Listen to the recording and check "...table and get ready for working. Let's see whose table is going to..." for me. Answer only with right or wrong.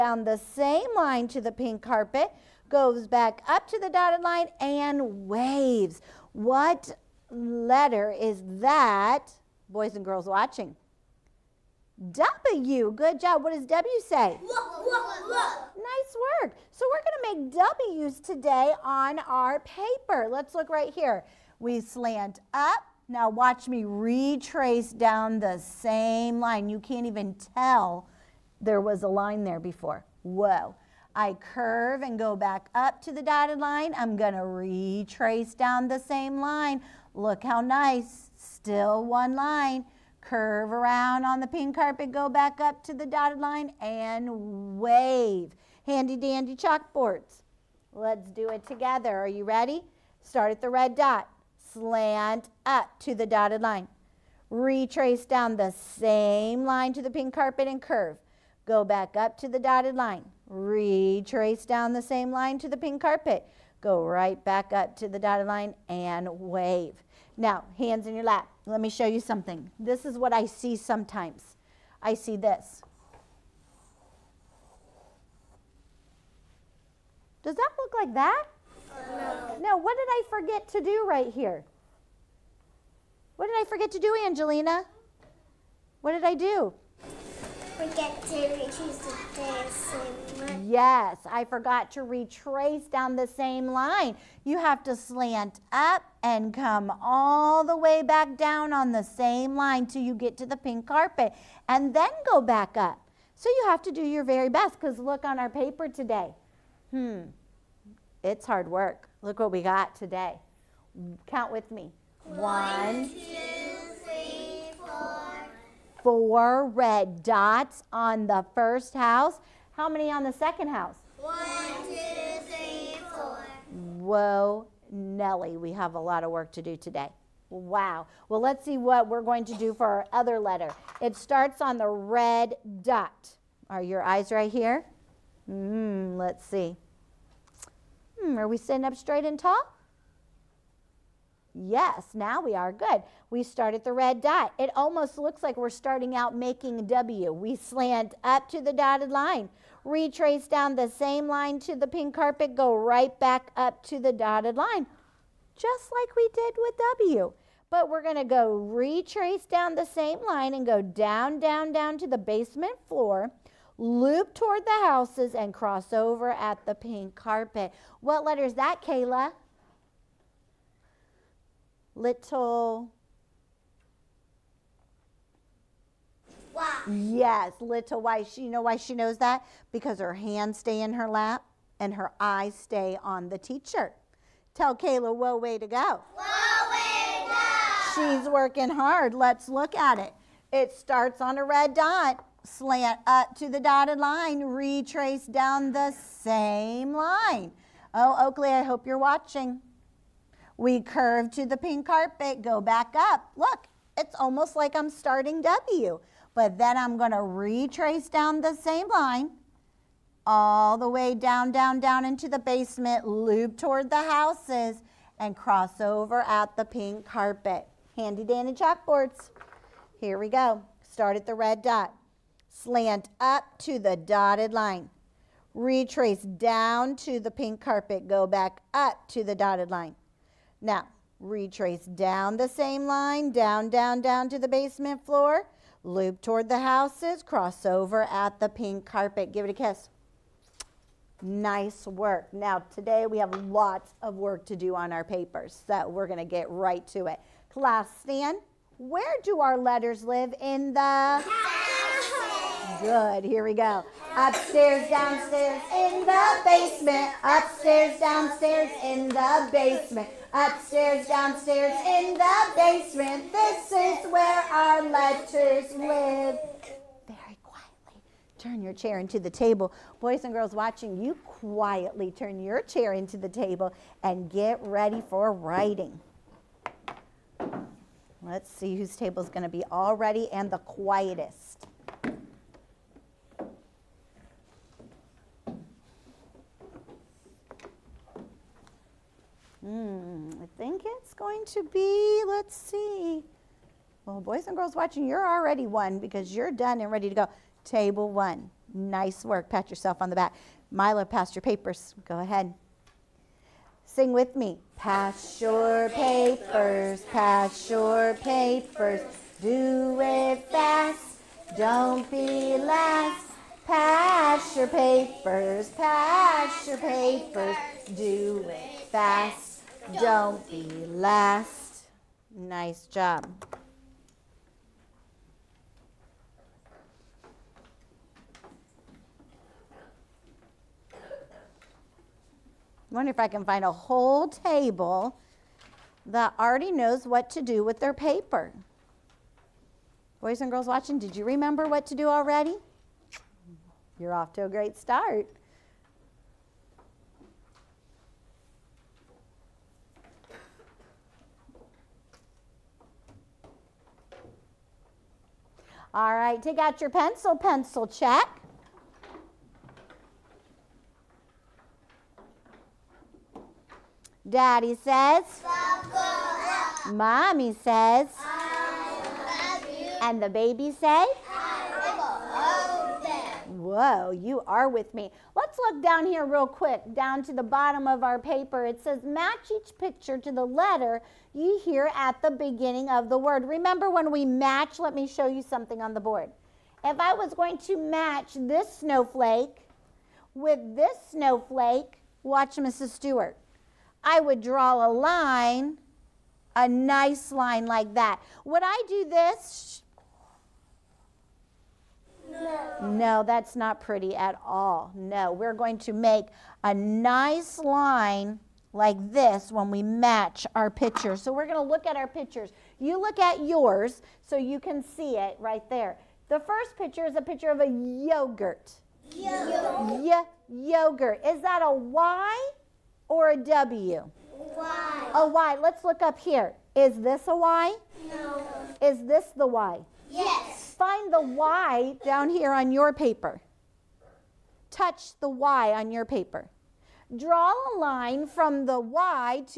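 wrong.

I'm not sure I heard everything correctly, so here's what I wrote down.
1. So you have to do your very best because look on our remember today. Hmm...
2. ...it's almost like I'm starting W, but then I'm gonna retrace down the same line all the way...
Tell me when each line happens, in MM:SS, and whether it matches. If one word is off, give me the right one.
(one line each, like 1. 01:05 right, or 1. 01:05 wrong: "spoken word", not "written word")
1. 01:43 wrong: "paper", not "remember"
2. 03:23 right.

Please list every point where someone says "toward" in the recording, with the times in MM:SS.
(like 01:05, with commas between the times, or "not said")
02:44, 03:33, 03:56.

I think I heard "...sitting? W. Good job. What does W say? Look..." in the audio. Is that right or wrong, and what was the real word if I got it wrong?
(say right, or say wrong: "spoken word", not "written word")
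wrong: "watching", not "sitting".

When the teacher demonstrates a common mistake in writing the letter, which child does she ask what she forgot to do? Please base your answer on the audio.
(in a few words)
Angelina.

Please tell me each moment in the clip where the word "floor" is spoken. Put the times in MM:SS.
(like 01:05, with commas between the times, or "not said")
02:42, 03:55.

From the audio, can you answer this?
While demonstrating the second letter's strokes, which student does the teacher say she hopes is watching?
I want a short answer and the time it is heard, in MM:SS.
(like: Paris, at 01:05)
Oakley, at 03:18.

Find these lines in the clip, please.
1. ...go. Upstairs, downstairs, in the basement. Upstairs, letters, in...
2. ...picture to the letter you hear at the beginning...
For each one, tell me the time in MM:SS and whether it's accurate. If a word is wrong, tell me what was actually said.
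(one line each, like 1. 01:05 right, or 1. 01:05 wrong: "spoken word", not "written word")
1. 04:13 wrong: "downstairs", not "letters"
2. 06:19 right.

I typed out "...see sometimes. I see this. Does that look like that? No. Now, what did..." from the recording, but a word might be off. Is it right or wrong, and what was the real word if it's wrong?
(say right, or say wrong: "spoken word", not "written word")
right.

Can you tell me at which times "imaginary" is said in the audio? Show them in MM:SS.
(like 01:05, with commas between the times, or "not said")
not said.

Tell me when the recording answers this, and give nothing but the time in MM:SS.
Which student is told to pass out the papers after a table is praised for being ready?
05:00.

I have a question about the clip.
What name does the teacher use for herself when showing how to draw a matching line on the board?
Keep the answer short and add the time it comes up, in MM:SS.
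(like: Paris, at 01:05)
Mrs. Stewart, at 06:32.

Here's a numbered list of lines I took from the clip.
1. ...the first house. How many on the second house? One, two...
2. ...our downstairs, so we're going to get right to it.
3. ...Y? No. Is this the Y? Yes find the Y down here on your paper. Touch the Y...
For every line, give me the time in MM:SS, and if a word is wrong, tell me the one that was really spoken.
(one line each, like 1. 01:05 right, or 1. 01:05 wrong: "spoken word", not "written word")
1. 01:58 right
2. 04:04 wrong: "papers", not "downstairs"
3. 07:07 right.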